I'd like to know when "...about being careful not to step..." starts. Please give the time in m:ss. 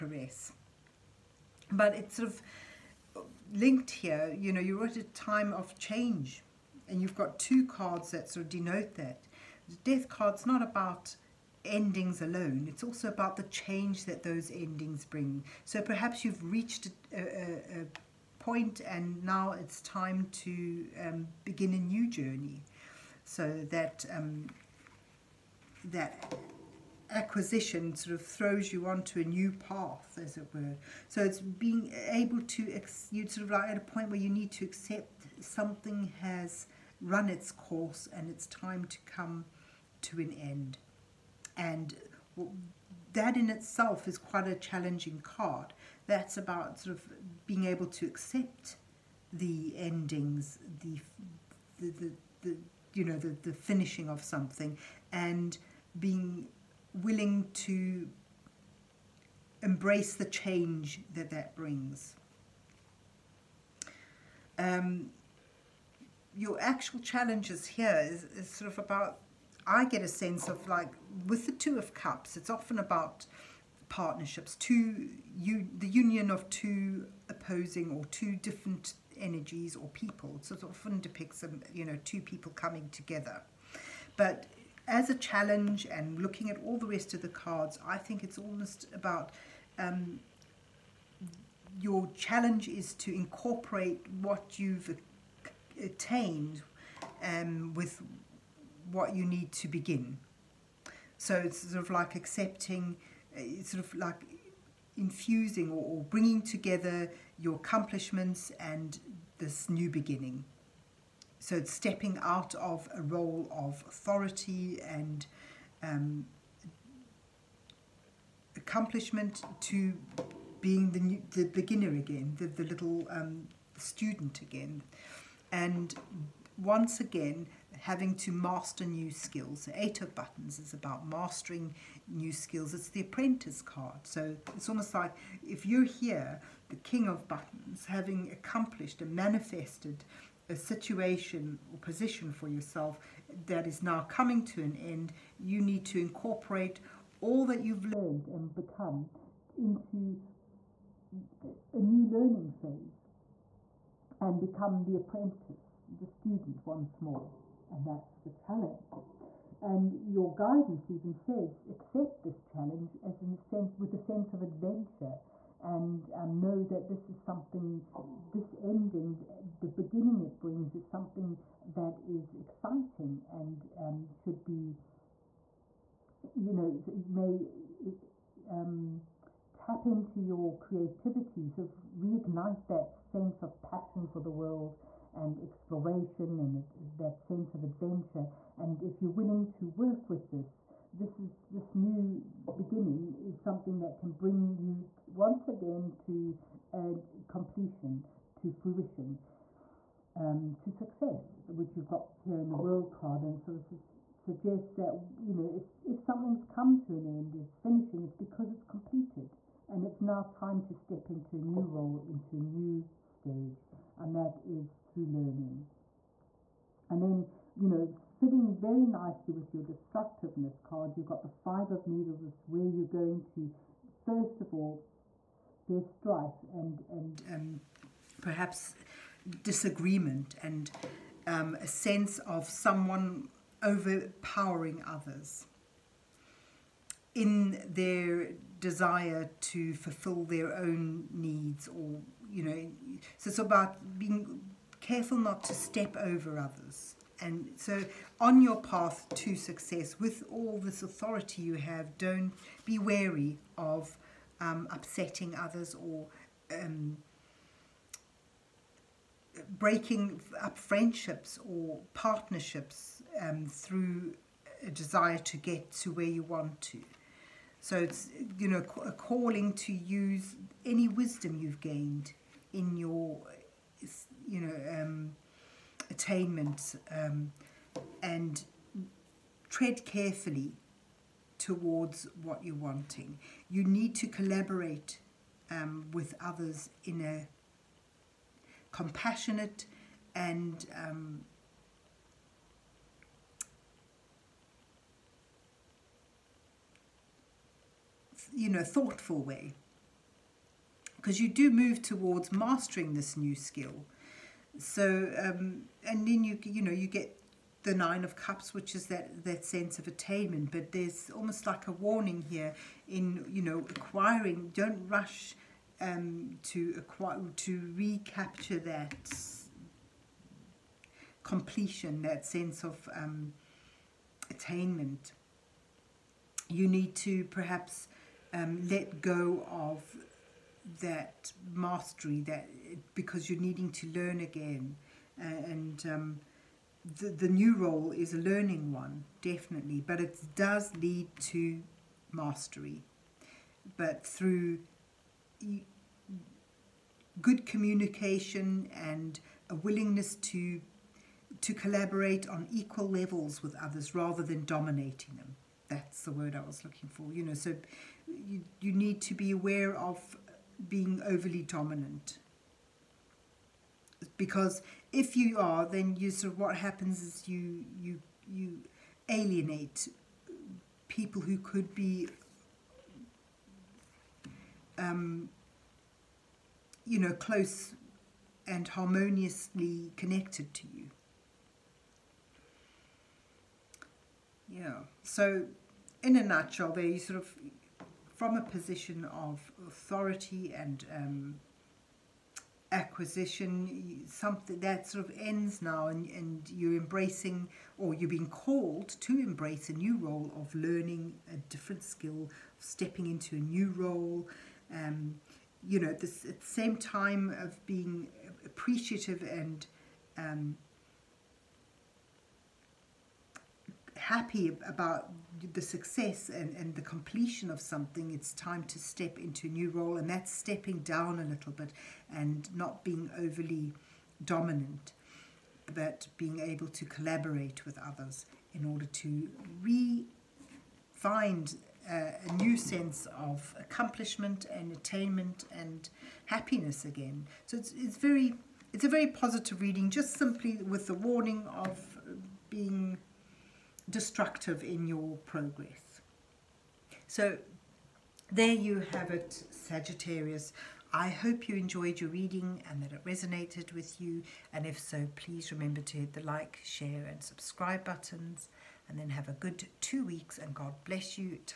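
4:03.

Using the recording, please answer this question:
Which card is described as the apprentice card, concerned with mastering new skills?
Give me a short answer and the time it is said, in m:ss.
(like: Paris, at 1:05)
Eight of Buttons, at 2:09.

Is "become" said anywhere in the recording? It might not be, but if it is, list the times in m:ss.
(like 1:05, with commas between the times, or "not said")
2:28, 2:34.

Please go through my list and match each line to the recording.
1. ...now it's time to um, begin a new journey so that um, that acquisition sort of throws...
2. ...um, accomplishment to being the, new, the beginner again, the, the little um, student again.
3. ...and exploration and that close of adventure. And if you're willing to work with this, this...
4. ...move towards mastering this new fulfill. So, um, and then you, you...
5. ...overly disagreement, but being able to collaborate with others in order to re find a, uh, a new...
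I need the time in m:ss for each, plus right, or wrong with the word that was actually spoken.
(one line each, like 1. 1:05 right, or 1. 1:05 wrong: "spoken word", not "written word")
1. 0:19 right
2. 1:55 right
3. 3:05 wrong: "sense", not "close"
4. 5:01 wrong: "skill", not "fulfill"
5. 7:03 wrong: "dominant", not "disagreement".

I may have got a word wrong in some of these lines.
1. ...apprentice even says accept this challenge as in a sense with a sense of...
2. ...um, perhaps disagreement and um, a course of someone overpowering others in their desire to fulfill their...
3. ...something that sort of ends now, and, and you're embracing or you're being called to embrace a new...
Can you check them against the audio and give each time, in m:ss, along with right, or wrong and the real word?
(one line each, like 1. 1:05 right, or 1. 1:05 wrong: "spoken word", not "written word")
1. 2:40 wrong: "guidance", not "apprentice"
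2. 3:47 wrong: "sense", not "course"
3. 6:34 right.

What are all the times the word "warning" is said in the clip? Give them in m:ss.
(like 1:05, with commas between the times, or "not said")
5:11, 7:20.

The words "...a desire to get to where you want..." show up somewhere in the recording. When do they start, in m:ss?
4:24.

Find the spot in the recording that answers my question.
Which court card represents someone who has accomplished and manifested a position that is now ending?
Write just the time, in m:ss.
2:16.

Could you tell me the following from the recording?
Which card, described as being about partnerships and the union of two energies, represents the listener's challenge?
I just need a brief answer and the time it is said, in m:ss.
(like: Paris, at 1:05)
Two of Cups, at 1:11.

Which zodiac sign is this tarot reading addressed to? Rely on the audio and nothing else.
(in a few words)
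Sagittarius.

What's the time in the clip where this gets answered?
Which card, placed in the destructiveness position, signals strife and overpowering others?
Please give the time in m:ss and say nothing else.
3:41.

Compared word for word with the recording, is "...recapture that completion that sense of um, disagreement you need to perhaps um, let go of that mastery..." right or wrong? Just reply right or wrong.
wrong.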